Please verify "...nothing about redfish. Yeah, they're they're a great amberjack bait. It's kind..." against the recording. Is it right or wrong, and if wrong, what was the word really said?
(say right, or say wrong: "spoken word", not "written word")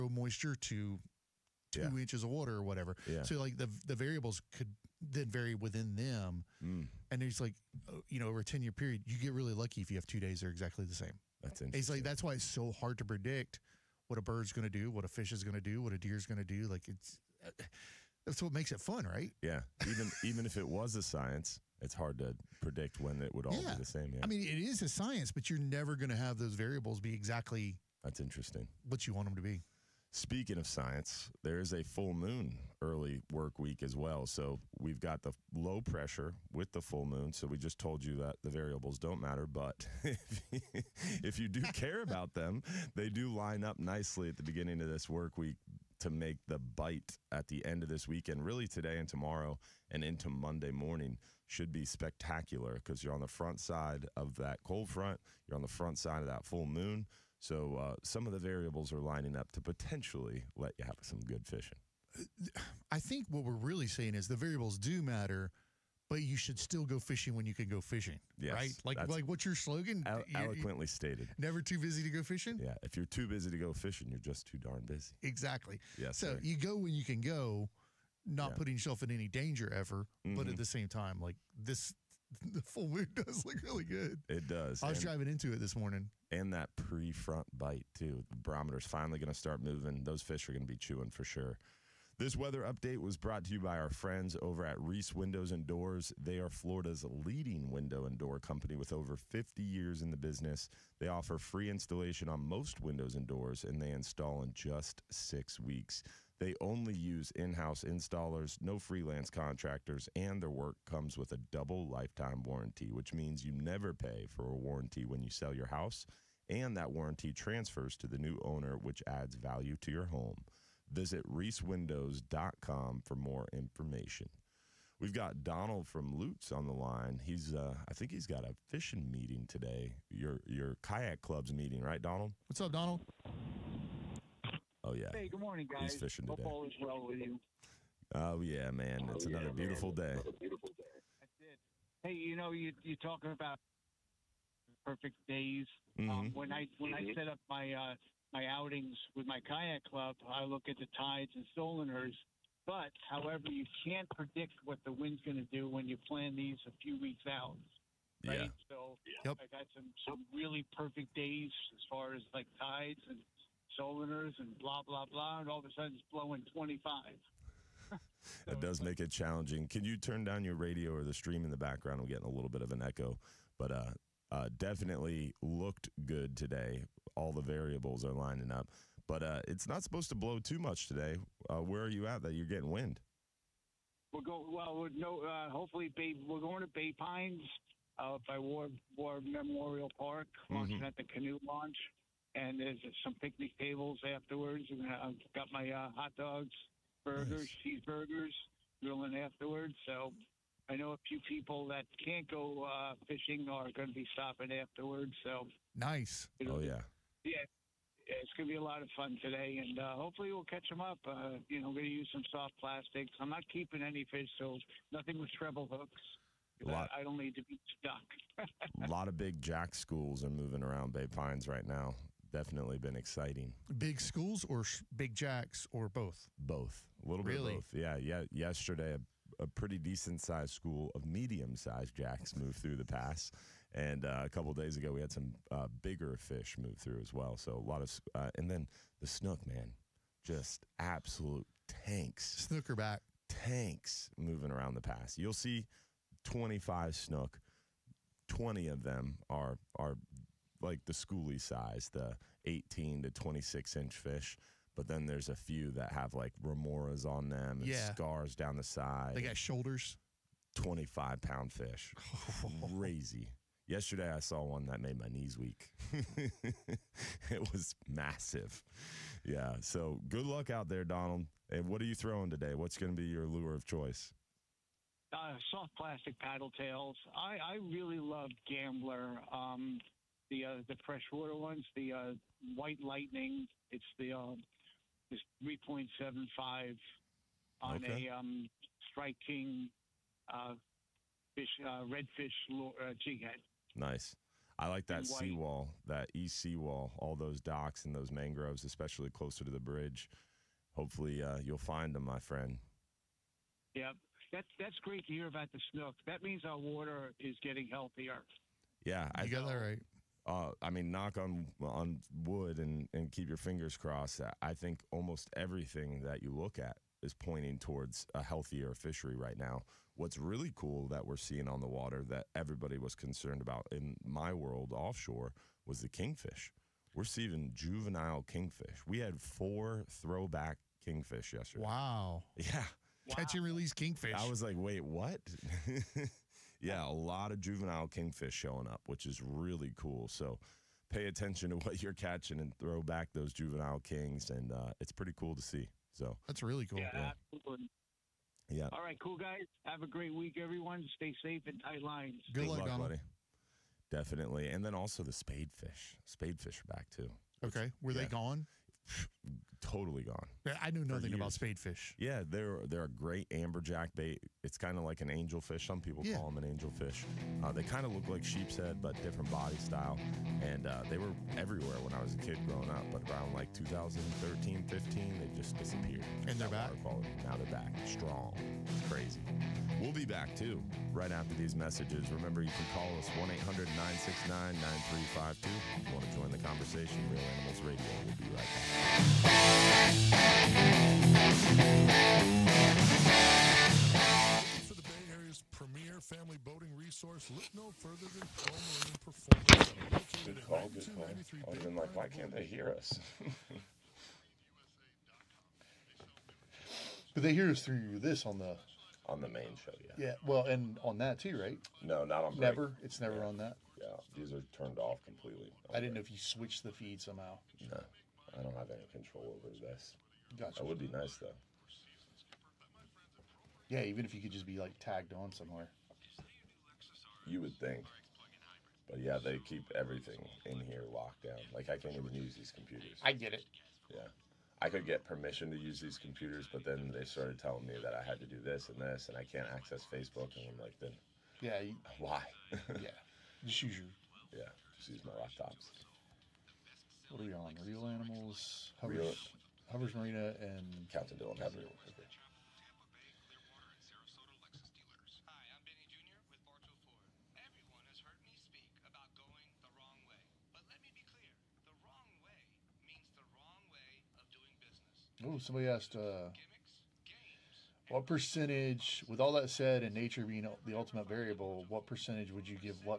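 wrong: "spadefish", not "redfish".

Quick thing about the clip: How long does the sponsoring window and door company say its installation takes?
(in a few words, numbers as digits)
6 weeks.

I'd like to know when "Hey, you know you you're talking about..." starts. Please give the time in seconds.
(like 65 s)
142 s.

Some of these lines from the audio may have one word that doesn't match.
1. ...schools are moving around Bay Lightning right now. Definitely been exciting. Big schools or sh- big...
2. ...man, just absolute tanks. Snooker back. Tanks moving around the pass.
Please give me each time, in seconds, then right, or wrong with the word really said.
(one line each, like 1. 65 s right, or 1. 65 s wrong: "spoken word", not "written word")
1. 219 s wrong: "Pines", not "Lightning"
2. 239 s right.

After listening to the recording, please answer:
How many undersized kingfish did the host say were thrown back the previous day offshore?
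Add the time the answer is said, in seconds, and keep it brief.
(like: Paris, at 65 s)
4, at 329 s.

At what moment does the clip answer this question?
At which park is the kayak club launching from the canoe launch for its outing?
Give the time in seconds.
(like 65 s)
188 s.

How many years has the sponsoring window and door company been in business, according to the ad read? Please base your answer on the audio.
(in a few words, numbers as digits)
over 50 years.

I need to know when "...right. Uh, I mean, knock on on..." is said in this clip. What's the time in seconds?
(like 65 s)
309 s.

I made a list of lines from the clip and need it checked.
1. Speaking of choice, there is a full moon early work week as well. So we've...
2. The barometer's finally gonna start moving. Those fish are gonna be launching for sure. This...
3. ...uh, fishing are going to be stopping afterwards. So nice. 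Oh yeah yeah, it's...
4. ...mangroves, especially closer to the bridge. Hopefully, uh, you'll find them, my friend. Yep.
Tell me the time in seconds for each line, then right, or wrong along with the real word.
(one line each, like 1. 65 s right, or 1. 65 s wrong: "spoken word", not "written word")
1. 30 s wrong: "science", not "choice"
2. 88 s wrong: "chewing", not "launching"
3. 202 s right
4. 298 s right.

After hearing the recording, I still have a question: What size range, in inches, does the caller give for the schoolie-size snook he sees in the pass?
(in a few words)
18 to 26 inches.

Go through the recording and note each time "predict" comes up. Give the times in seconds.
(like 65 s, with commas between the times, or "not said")
13 s, 22 s, 154 s.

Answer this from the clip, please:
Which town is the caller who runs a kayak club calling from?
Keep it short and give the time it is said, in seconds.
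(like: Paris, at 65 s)
Lutz, at 126 s.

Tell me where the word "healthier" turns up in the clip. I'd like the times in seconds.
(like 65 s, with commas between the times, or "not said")
307 s, 318 s.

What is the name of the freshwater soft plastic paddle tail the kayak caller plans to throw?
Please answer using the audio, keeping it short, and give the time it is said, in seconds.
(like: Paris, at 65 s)
White Lightning, at 282 s.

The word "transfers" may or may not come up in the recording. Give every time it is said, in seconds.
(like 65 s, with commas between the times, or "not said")
117 s.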